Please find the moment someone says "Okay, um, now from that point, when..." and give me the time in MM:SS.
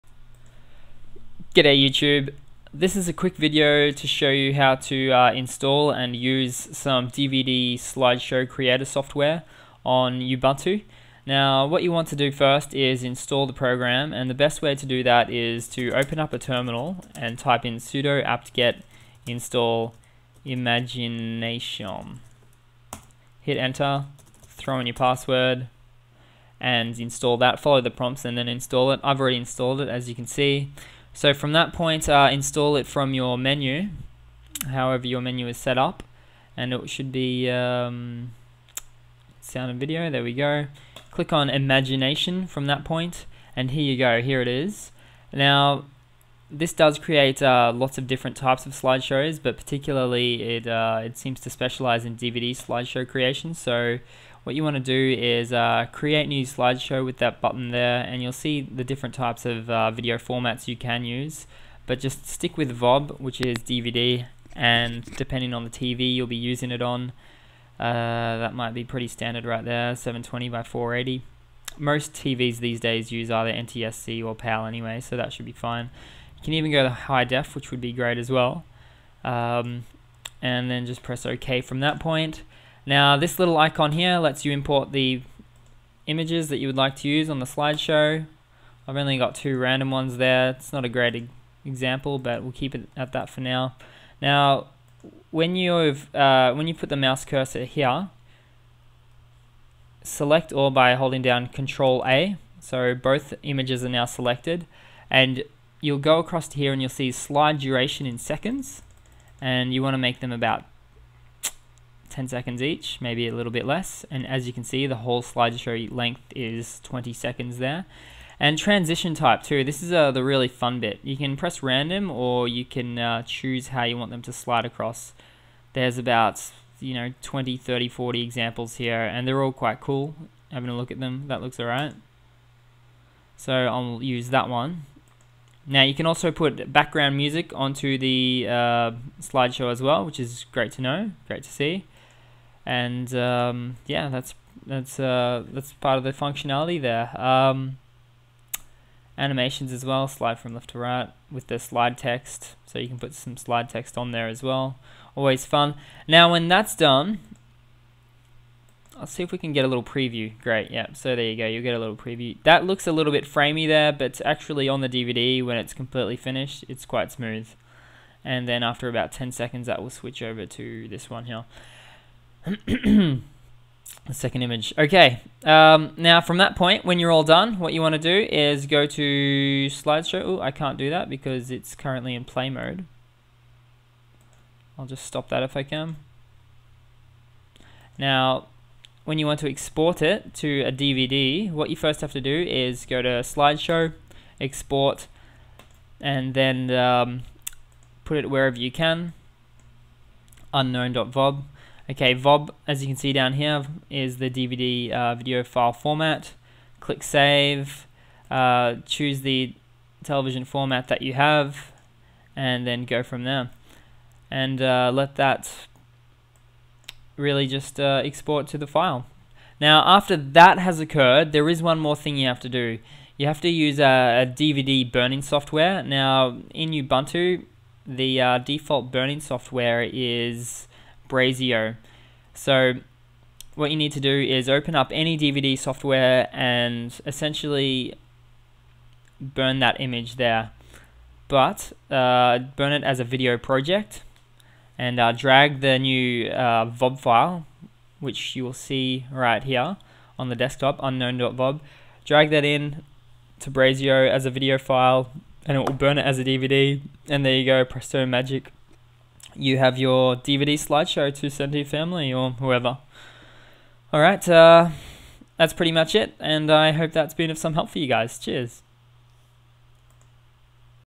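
02:54.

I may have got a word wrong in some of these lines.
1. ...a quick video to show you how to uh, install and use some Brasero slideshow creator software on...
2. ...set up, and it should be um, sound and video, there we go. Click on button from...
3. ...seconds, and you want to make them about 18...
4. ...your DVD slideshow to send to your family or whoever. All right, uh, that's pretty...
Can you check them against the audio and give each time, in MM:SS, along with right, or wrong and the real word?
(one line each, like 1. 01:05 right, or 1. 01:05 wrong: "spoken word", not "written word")
1. 00:03 wrong: "DVD", not "Brasero"
2. 00:35 wrong: "imagination", not "button"
3. 01:48 wrong: "10", not "18"
4. 04:19 right.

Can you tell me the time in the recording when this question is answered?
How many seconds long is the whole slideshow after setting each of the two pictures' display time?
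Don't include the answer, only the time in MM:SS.
01:56.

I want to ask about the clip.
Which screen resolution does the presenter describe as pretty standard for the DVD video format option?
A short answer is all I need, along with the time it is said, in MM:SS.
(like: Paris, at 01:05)
720 by 480, at 01:09.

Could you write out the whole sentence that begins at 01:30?
It's not a great example, but we'll keep it at that for now.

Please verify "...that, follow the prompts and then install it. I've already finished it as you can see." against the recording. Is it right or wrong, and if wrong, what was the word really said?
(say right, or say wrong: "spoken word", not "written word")
wrong: "installed", not "finished".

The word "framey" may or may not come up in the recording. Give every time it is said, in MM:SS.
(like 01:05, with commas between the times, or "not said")
02:43.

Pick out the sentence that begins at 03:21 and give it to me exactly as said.
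Okay, VOB, as you can see down here, is the DVD uh, video file format.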